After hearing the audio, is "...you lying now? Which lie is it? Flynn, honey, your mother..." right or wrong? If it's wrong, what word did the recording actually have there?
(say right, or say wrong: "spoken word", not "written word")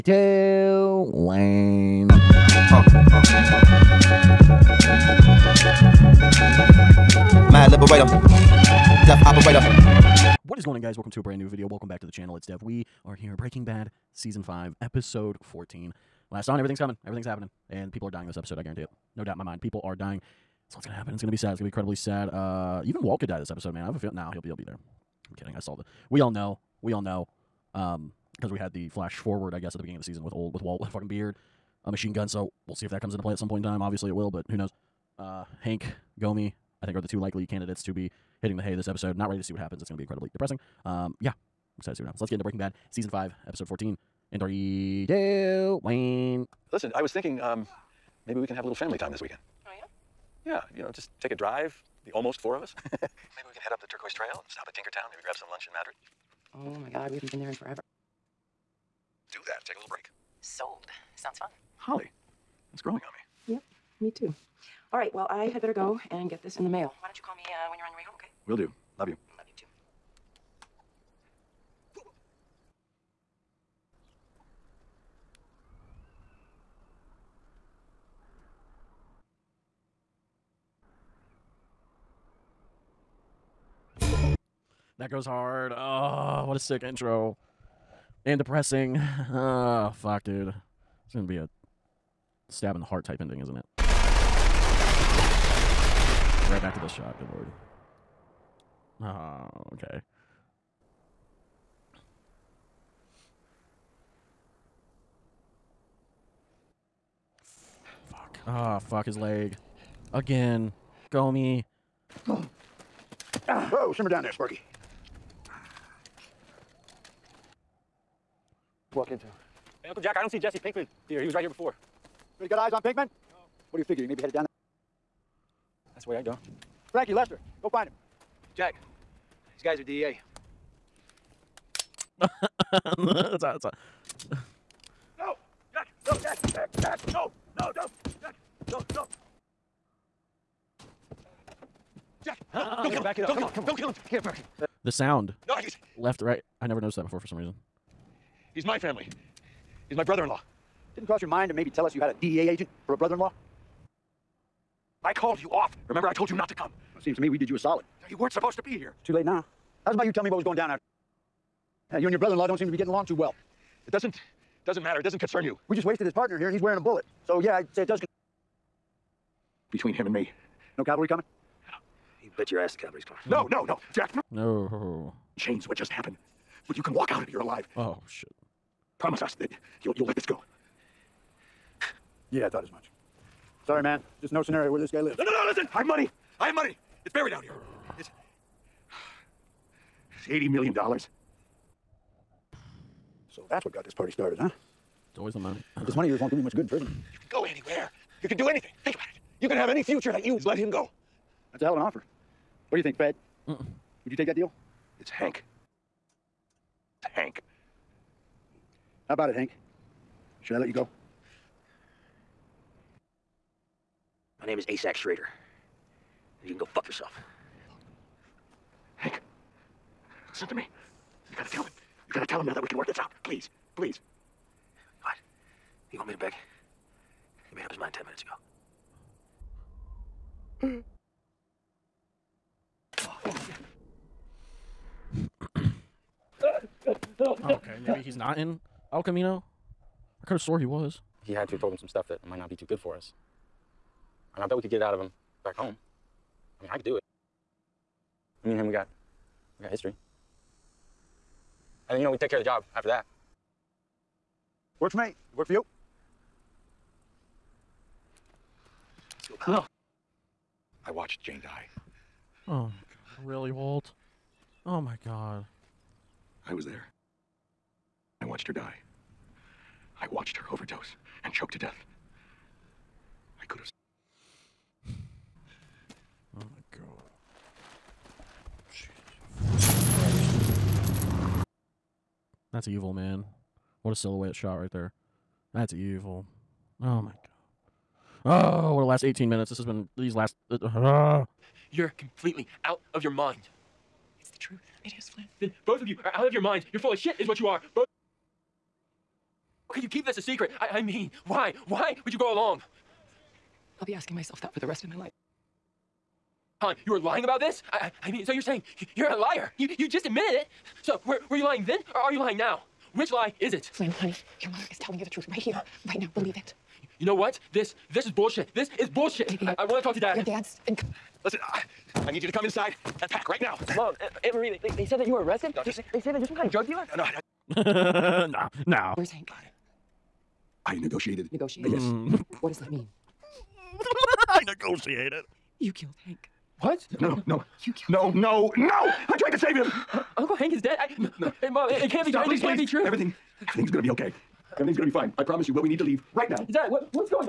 right.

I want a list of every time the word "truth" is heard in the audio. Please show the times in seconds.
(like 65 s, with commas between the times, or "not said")
294 s, 315 s.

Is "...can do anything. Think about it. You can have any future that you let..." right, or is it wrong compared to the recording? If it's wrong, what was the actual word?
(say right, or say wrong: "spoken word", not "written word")
right.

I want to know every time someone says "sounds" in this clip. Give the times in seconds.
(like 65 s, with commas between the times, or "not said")
61 s, 144 s.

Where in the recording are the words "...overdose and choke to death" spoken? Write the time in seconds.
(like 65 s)
270 s.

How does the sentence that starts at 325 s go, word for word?
Don't you They, they, say that you're some kind of drug dealer?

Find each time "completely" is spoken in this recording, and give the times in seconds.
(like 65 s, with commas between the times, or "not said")
291 s.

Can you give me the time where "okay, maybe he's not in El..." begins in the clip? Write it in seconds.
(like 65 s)
237 s.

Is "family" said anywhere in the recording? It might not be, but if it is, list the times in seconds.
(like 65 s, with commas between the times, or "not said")
48 s, 148 s.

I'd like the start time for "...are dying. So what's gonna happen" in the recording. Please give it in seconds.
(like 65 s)
19 s.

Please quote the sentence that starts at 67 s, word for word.
Why don't you call me uh, when you're on your way home, okay?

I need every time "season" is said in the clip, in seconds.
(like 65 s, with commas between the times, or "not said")
14 s, 30 s, 42 s.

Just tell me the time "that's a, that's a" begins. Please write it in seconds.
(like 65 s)
132 s.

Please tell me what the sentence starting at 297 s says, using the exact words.
Both How could you keep this a secret?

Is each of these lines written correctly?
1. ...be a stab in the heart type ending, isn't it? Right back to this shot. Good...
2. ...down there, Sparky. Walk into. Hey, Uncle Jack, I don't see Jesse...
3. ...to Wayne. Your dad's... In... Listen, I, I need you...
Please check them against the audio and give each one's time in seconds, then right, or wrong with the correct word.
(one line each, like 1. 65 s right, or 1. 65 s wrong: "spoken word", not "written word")
1. 91 s right
2. 114 s right
3. 319 s wrong: "Dad", not "Wayne".